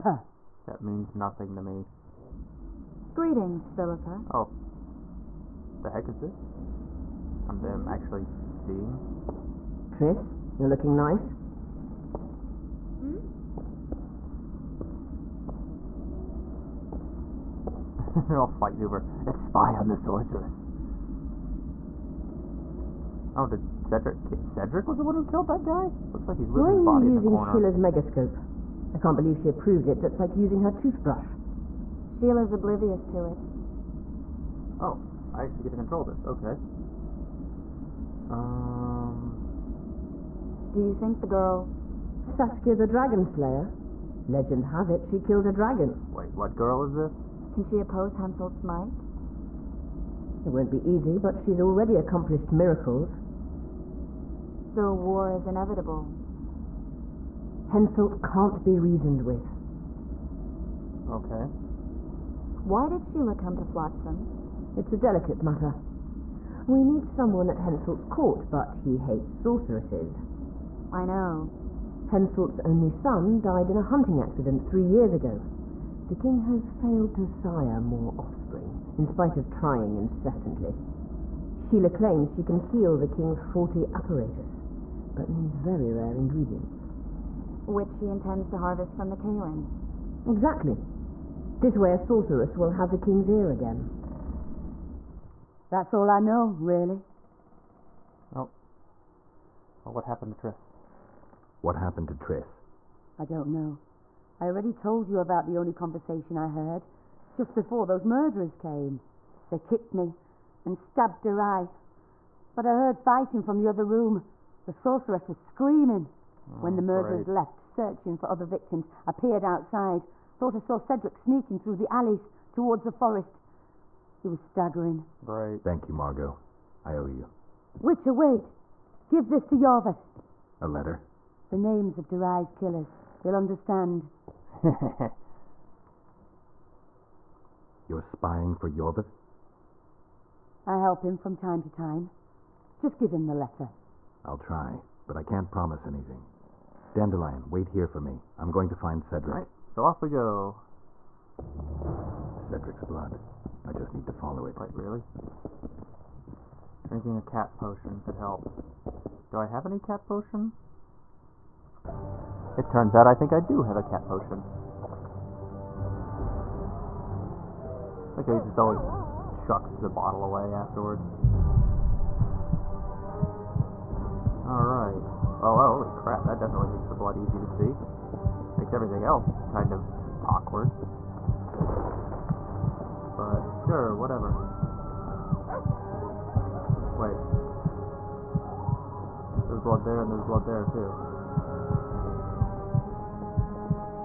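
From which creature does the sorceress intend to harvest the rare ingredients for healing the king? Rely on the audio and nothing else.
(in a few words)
The Kayran.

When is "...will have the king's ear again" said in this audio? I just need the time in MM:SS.
01:32.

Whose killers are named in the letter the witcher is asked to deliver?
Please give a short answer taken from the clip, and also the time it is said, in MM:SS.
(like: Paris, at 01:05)
Durai, at 02:12.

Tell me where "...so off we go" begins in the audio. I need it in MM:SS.
02:29.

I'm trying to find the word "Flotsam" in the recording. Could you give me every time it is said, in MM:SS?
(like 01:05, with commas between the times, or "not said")
01:03.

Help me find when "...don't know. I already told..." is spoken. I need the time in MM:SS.
01:43.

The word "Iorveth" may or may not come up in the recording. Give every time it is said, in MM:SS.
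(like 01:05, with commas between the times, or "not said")
02:09, 02:18.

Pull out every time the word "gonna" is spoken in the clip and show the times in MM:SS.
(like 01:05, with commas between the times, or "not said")
not said.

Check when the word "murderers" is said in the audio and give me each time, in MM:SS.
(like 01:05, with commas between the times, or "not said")
01:48, 01:56.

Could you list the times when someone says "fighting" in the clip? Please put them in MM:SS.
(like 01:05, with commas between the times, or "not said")
00:18, 01:52.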